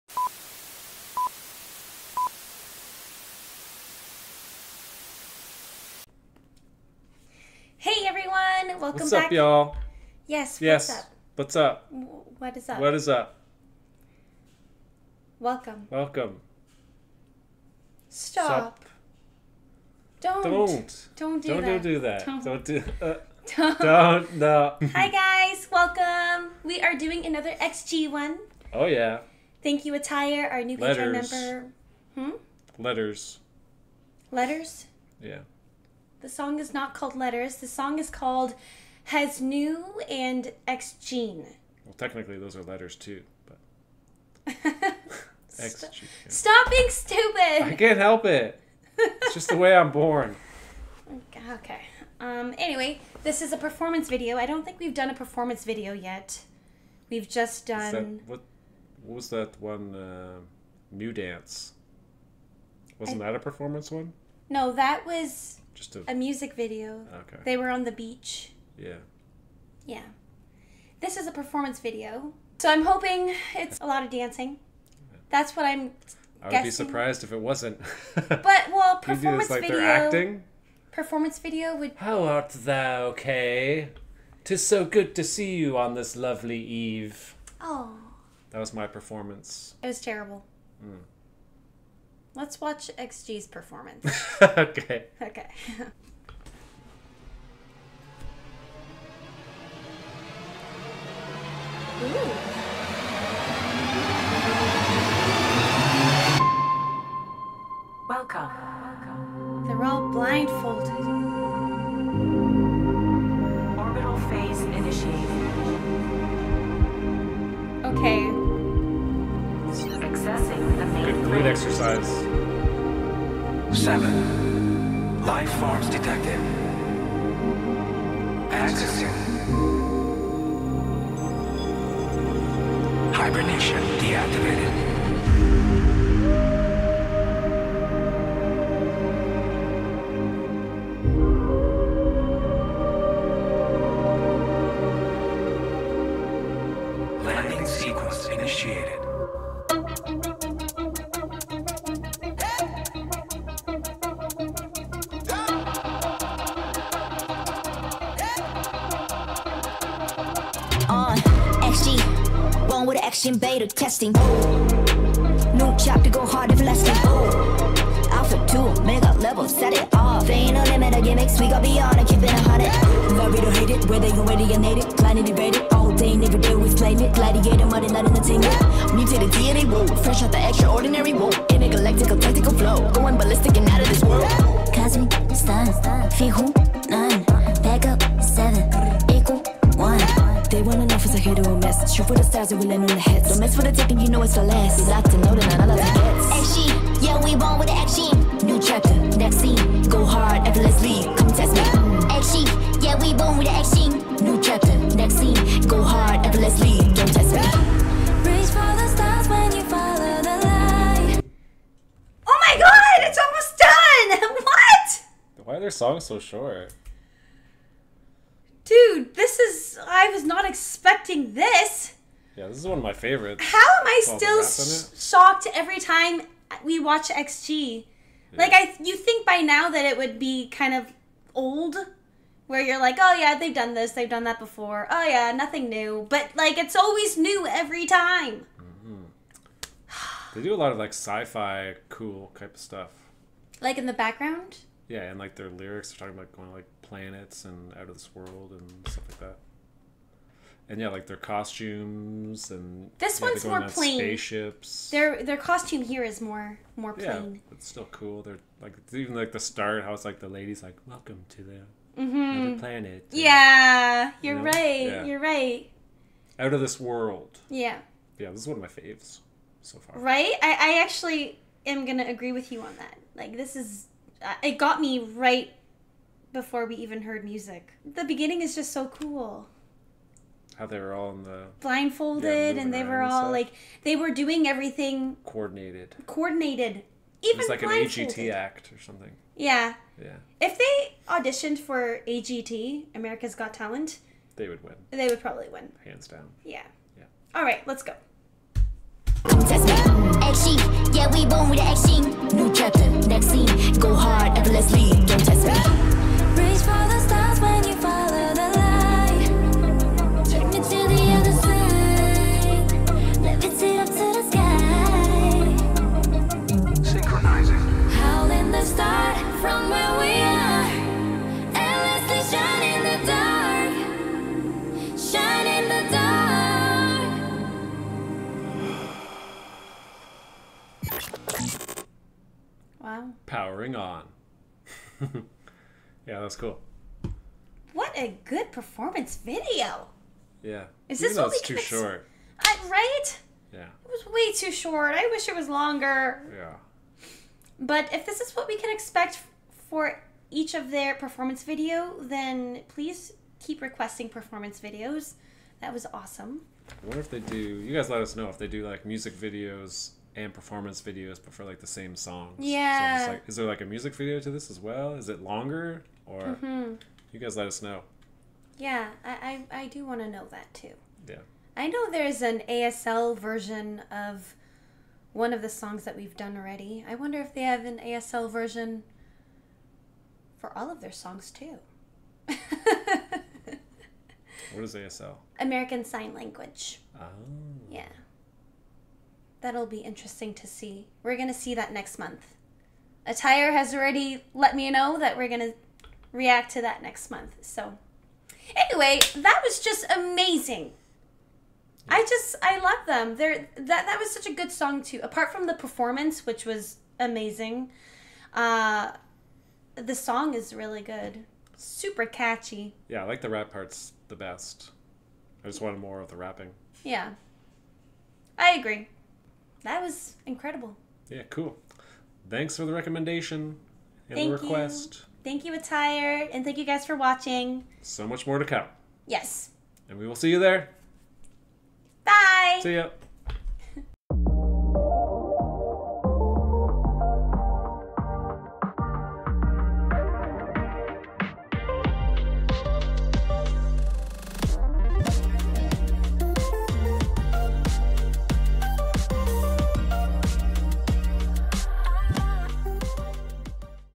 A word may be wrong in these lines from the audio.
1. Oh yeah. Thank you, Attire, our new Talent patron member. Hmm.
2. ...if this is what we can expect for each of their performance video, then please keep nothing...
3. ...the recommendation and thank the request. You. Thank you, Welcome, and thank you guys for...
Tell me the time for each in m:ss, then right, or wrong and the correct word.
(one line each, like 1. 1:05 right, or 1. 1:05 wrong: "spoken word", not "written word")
1. 0:28 wrong: "Patreon", not "Talent"
2. 5:47 wrong: "requesting", not "nothing"
3. 7:02 wrong: "Attire", not "Welcome".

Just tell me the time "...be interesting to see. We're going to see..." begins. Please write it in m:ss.
6:29.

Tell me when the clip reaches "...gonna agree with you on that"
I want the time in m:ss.
4:31.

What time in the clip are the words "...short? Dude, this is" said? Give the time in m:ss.
3:36.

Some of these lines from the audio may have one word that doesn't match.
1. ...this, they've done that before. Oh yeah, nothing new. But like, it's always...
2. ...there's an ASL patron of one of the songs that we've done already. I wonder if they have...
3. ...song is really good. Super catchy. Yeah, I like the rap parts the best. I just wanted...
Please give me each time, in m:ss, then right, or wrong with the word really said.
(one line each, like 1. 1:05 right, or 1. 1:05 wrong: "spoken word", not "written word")
1. 3:53 right
2. 6:11 wrong: "version", not "patron"
3. 6:49 right.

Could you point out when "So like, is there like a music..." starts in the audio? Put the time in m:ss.
6:03.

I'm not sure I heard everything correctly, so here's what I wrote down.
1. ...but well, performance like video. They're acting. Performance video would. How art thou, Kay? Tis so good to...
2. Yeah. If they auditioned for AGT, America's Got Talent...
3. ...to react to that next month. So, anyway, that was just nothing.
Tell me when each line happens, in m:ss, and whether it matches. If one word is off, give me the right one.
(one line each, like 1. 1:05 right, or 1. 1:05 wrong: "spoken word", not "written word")
1. 1:18 right
2. 4:50 right
3. 6:35 wrong: "amazing", not "nothing".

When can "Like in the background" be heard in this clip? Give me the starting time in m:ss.
4:03.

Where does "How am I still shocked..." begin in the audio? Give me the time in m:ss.
3:43.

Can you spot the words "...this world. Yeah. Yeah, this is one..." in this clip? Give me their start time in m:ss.
4:26.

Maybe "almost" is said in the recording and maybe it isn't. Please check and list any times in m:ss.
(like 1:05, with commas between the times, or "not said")
3:33.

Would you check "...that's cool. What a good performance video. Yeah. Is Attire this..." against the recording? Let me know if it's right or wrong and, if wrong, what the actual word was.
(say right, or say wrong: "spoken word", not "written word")
wrong: "Even", not "Attire".